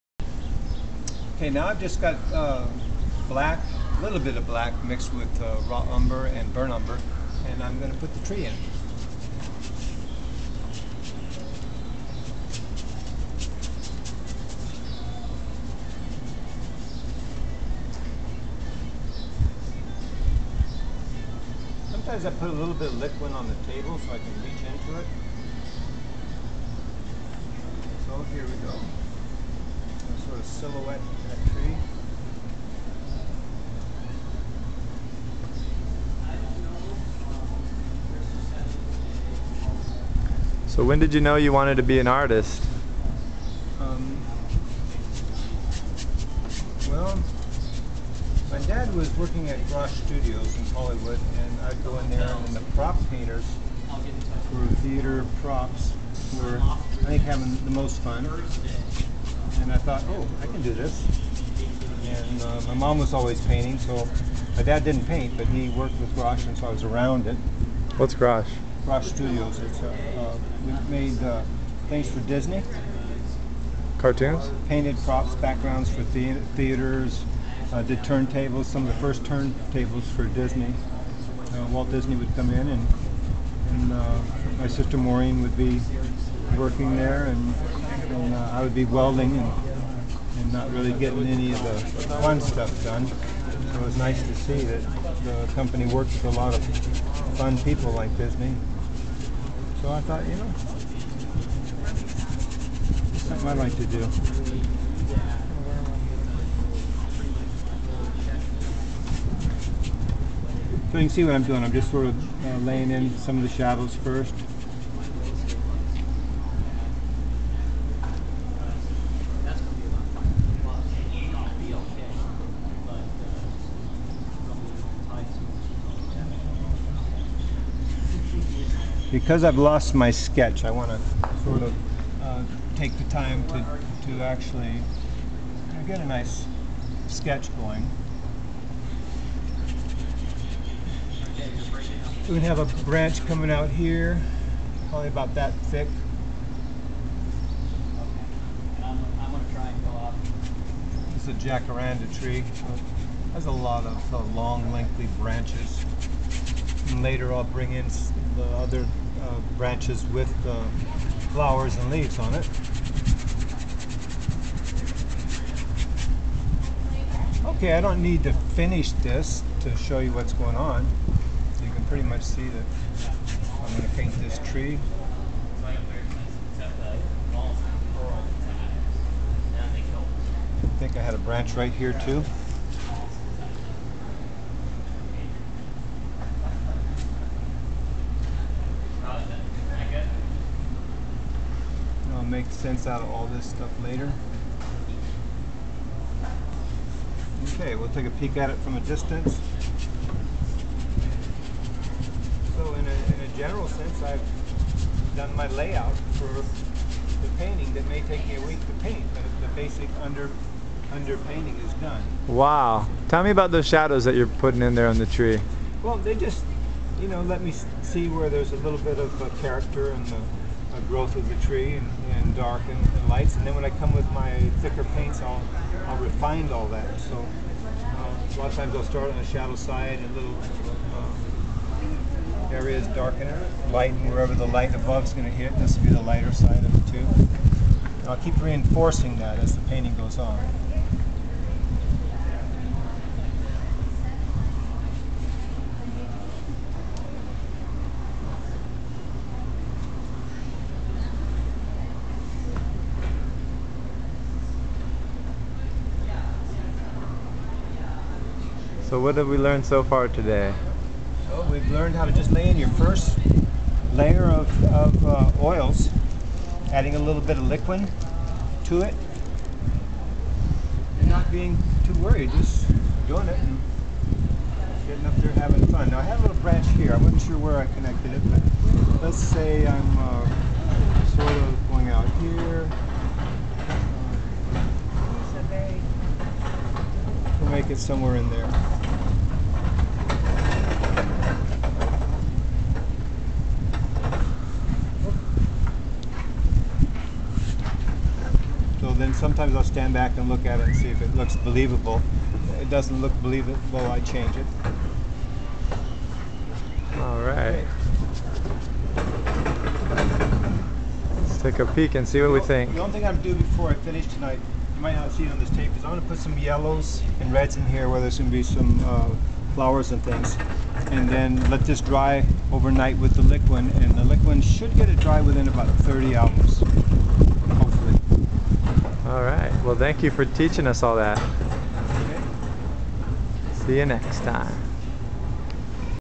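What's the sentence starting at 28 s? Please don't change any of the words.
So here we go sort of silhouette in that tree.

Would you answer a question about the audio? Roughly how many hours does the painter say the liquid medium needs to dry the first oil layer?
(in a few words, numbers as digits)
30.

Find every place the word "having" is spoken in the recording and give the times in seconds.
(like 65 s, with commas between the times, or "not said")
57 s, 275 s.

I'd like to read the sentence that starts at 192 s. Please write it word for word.
make sense out of all this stuff later.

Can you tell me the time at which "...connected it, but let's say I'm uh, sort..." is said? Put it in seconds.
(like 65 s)
277 s.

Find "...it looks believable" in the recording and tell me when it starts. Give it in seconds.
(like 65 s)
301 s.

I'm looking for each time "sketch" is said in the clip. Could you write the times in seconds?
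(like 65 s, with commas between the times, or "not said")
130 s, 137 s.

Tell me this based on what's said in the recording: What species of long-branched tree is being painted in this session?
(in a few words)
jacaranda.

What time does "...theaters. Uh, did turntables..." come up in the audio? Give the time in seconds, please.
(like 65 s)
76 s.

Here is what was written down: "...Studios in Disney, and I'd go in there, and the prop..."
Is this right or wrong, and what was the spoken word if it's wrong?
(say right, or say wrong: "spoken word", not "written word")
wrong: "Hollywood", not "Disney".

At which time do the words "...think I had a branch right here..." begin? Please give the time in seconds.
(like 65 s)
180 s.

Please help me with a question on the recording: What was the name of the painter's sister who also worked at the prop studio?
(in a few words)
Maureen.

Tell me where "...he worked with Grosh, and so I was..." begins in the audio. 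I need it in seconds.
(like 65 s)
65 s.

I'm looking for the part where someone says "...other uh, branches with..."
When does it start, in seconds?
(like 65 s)
158 s.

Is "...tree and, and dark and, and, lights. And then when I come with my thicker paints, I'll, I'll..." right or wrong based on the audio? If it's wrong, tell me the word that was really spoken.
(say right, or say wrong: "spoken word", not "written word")
right.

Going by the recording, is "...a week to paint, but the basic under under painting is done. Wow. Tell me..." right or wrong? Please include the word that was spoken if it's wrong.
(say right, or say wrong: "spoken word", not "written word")
right.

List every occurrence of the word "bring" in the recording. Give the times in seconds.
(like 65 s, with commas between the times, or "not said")
157 s.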